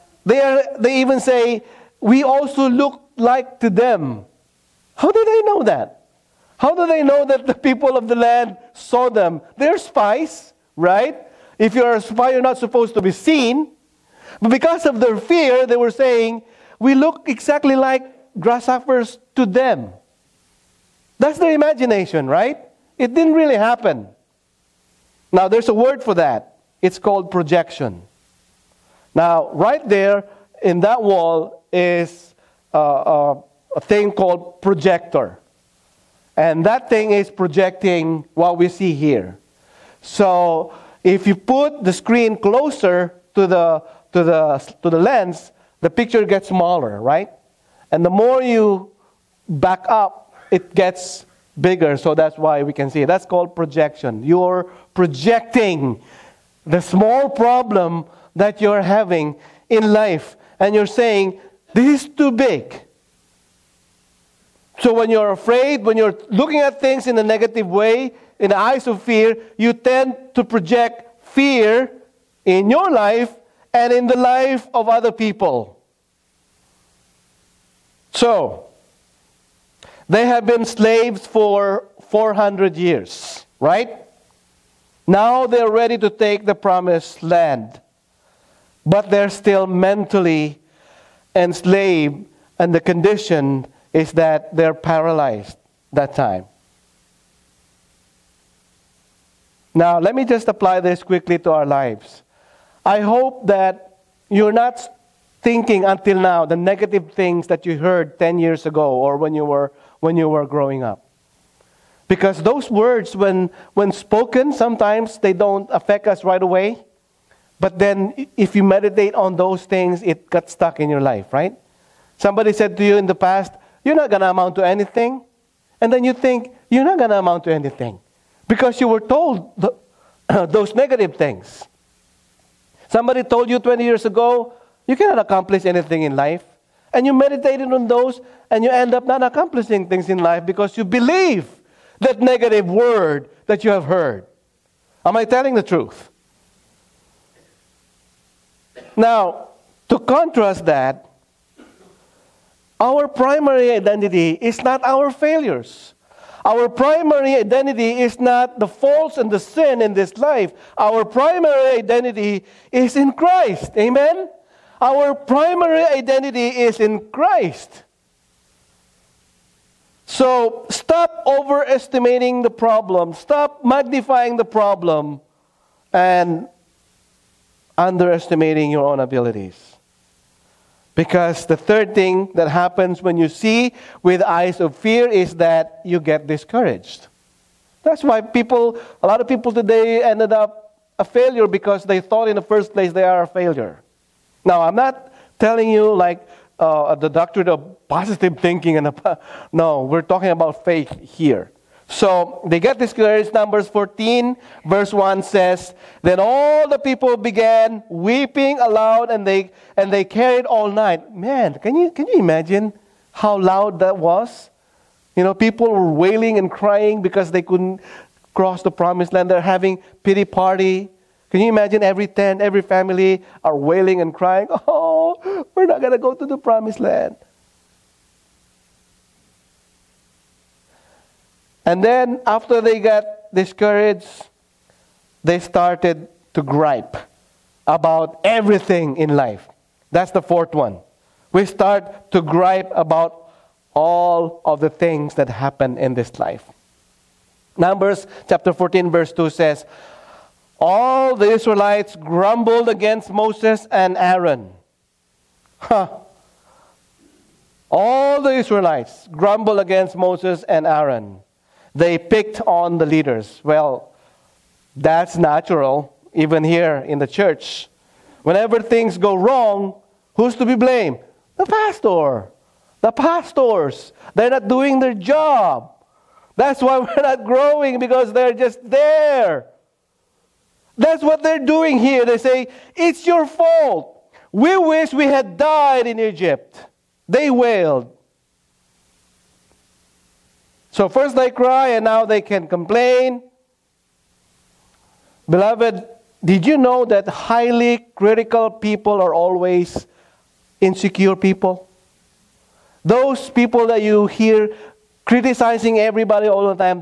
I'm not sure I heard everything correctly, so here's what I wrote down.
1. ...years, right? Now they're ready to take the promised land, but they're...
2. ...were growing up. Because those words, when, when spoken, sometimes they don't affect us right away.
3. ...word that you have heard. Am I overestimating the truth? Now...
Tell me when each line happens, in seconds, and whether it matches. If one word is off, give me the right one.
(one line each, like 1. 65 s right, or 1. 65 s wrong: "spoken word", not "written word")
1. 82 s right
2. 110 s right
3. 142 s wrong: "telling", not "overestimating".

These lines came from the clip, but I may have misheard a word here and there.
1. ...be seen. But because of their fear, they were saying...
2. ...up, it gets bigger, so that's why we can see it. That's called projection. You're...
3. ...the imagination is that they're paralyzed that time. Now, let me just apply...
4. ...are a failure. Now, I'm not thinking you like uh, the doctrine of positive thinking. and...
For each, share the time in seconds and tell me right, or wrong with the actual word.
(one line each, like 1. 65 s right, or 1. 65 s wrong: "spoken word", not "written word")
1. 13 s right
2. 49 s right
3. 92 s wrong: "condition", not "imagination"
4. 193 s wrong: "telling", not "thinking".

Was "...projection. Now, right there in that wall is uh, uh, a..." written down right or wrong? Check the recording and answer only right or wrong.
right.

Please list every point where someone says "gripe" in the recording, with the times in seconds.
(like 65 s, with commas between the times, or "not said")
236 s, 242 s.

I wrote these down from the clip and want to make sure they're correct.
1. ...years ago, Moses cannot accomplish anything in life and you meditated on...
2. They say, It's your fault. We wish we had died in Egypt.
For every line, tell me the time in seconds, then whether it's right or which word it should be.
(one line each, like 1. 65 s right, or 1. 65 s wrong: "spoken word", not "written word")
1. 133 s wrong: "You", not "Moses"
2. 282 s right.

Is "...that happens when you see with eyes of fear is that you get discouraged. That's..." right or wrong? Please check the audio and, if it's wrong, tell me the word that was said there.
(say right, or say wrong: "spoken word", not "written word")
right.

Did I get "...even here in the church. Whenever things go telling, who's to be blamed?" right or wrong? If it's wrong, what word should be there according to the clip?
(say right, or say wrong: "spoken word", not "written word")
wrong: "wrong", not "telling".